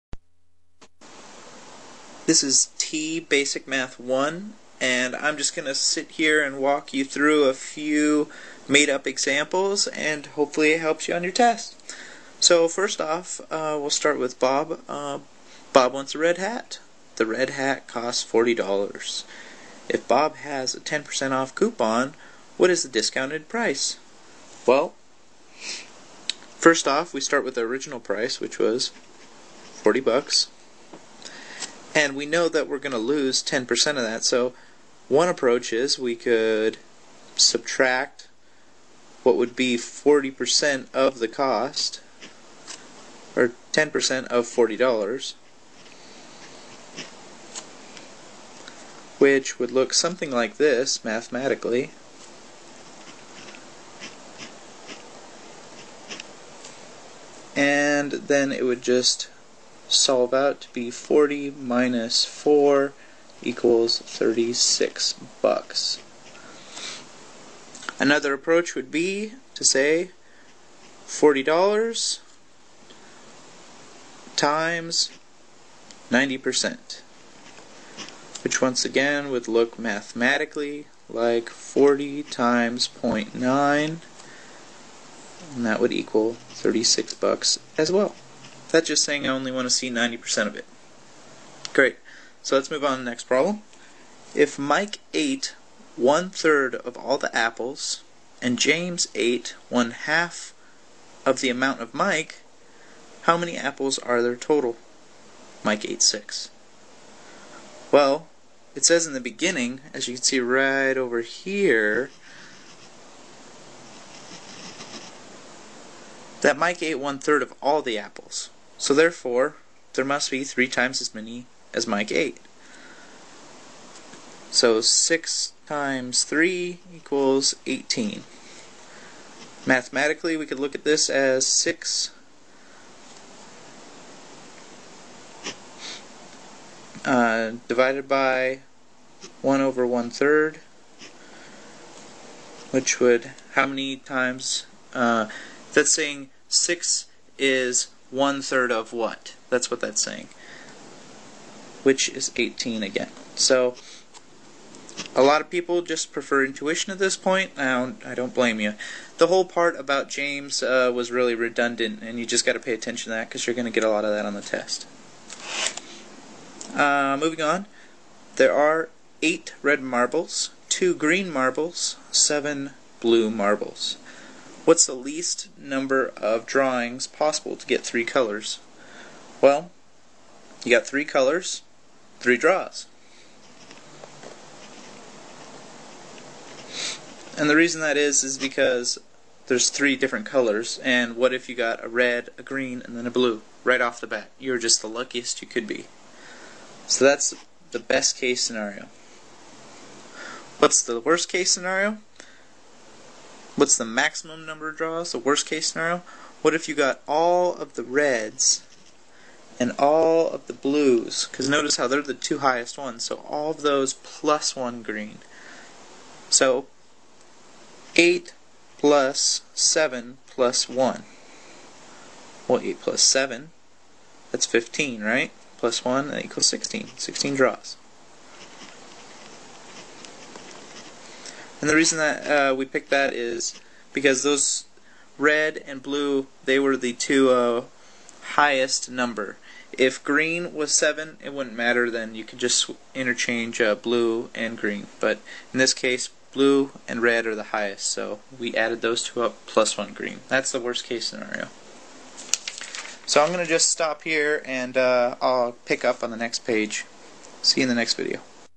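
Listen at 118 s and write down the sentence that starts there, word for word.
So therefore there must be 3 times as many as Mike ate.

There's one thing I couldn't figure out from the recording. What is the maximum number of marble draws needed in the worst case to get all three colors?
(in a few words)
16.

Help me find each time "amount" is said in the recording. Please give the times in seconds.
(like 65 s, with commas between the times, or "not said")
101 s.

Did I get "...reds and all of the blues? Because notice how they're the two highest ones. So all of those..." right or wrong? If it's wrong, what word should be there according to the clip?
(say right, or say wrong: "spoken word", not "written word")
right.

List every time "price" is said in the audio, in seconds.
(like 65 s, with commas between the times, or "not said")
23 s, 27 s.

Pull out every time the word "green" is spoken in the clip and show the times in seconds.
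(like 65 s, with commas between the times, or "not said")
170 s, 192 s, 214 s, 240 s, 244 s, 249 s.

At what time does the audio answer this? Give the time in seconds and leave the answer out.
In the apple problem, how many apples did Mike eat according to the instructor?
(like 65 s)
105 s.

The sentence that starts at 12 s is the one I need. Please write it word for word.
So first off, uh, we'll start with Bob.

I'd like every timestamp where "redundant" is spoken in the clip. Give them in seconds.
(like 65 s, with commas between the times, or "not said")
161 s.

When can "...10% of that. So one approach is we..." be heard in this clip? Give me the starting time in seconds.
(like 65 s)
33 s.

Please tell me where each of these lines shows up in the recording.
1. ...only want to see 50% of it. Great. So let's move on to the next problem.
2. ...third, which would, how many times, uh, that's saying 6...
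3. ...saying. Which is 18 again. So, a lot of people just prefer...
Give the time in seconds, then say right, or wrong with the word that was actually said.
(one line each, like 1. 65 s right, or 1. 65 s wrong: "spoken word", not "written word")
1. 89 s wrong: "90", not "50"
2. 140 s right
3. 150 s right.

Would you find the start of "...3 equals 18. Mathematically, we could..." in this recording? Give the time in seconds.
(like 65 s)
126 s.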